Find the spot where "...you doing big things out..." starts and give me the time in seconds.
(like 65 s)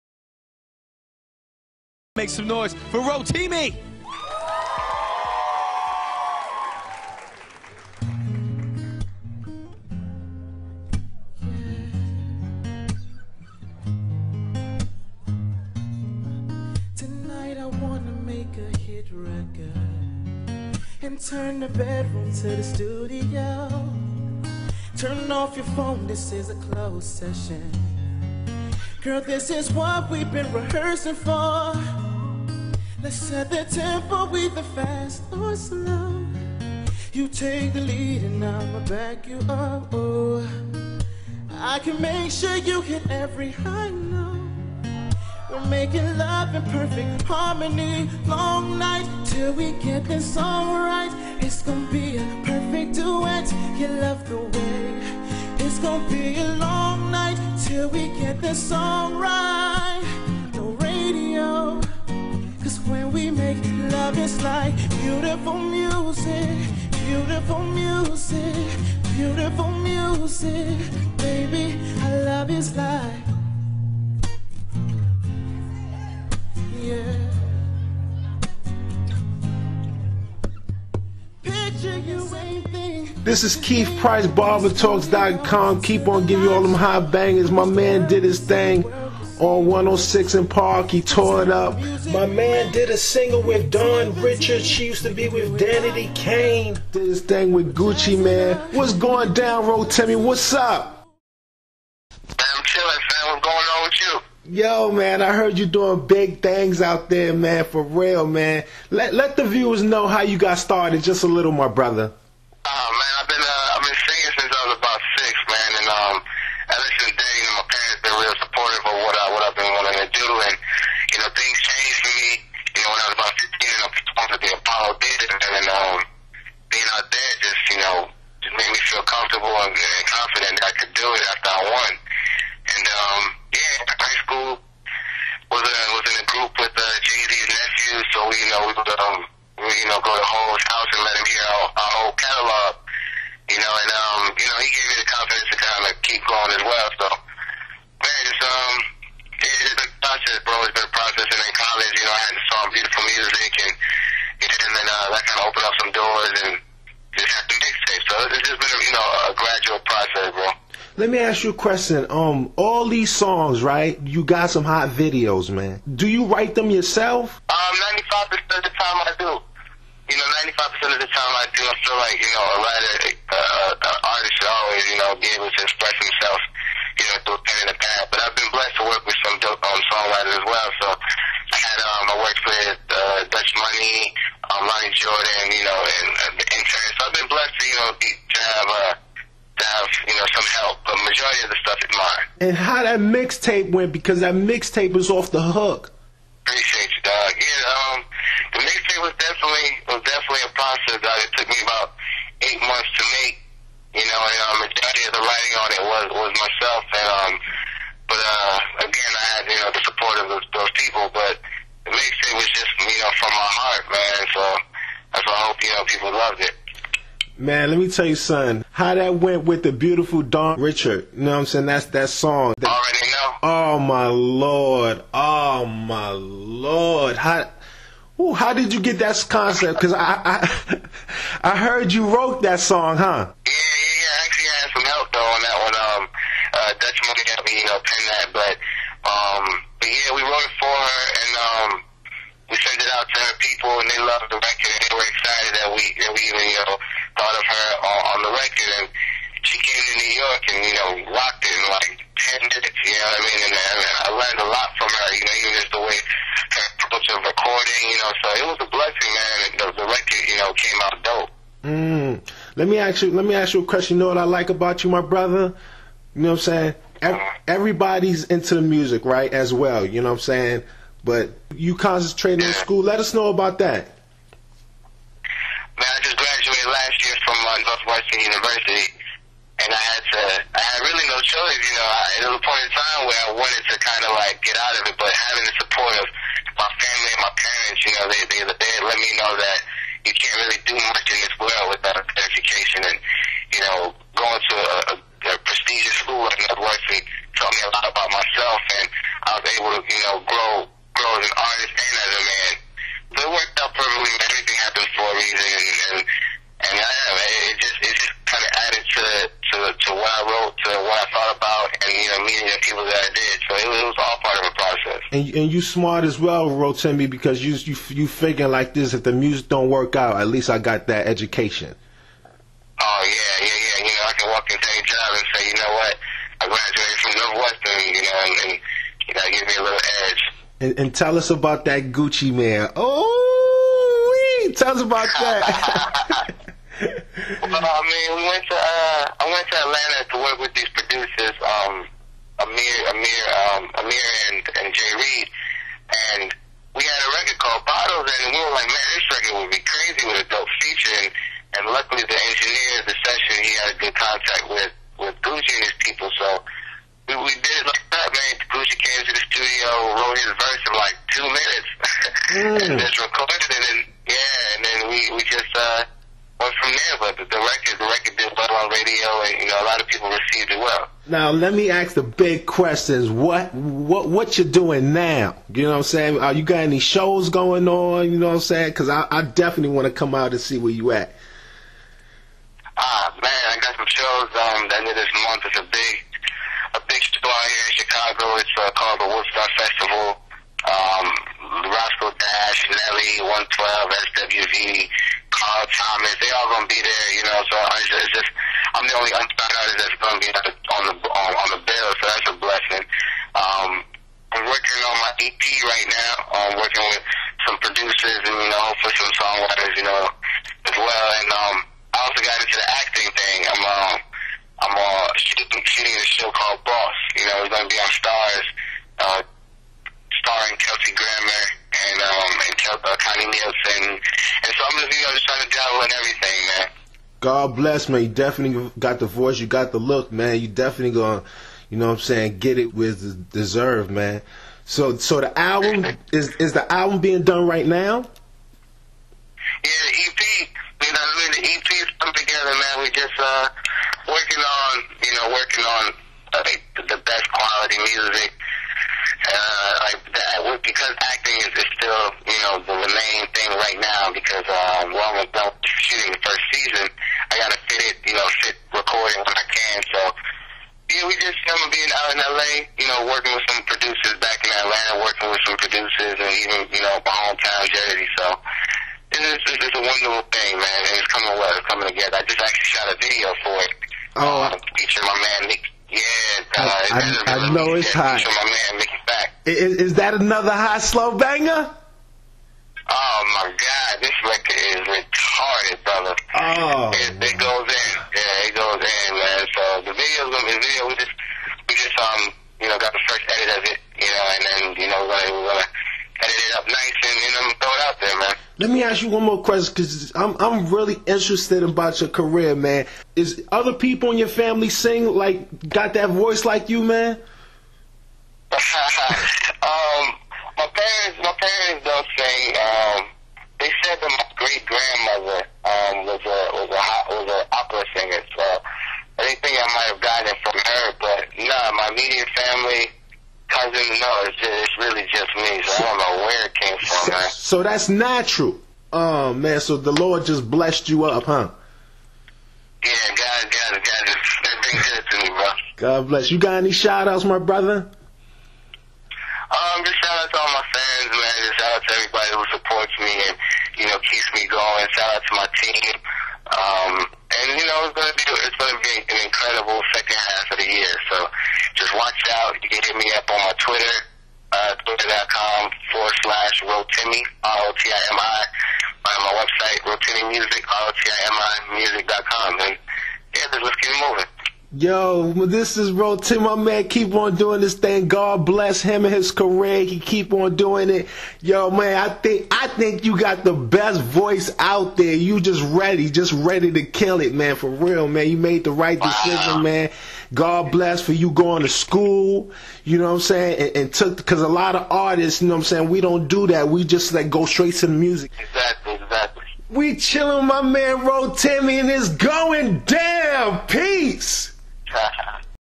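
105 s.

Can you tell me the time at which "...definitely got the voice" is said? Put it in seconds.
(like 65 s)
428 s.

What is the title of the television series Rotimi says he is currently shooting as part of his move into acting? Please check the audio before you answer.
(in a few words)
Boss.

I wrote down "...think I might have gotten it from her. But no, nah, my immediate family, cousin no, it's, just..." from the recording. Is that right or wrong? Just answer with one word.
right.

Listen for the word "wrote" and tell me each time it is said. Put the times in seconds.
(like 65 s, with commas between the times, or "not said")
232 s, 240 s, 310 s, 360 s.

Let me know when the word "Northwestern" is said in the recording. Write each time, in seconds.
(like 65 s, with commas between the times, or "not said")
277 s, 296 s, 327 s.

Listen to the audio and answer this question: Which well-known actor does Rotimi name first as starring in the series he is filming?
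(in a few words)
Kelsey Grammer.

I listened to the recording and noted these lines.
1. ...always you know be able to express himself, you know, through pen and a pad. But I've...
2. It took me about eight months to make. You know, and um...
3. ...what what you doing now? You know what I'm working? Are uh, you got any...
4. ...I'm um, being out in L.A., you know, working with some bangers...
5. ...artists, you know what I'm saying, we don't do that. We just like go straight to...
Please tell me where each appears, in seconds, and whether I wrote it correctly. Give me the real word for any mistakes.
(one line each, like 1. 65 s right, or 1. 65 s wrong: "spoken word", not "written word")
1. 174 s right
2. 201 s right
3. 373 s wrong: "saying", not "working"
4. 461 s wrong: "producers", not "bangers"
5. 584 s right.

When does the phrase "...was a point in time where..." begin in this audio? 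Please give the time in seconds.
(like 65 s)
282 s.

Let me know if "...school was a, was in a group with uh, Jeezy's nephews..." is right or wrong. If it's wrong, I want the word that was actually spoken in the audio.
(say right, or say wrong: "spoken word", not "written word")
right.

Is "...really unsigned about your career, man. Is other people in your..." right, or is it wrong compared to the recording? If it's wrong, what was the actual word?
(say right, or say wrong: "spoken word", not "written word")
wrong: "interested", not "unsigned".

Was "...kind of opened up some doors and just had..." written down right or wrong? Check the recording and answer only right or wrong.
right.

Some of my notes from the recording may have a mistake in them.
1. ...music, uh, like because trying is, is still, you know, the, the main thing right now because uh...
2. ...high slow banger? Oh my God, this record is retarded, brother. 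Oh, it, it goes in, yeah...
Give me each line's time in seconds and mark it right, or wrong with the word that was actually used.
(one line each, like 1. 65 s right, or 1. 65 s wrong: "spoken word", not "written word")
1. 447 s wrong: "acting", not "trying"
2. 480 s right.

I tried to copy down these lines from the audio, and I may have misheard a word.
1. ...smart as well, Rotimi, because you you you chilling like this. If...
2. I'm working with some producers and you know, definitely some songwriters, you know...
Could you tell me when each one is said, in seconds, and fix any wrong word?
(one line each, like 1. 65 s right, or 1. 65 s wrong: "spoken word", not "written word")
1. 315 s wrong: "figuring", not "chilling"
2. 406 s wrong: "hopefully", not "definitely".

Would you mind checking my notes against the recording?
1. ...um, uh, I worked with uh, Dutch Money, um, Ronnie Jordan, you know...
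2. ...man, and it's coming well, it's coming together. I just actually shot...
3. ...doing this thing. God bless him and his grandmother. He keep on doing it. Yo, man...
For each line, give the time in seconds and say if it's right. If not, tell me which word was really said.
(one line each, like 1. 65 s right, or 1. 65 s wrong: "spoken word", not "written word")
1. 181 s right
2. 470 s right
3. 567 s wrong: "career", not "grandmother".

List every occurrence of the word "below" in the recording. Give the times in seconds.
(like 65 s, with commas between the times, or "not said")
not said.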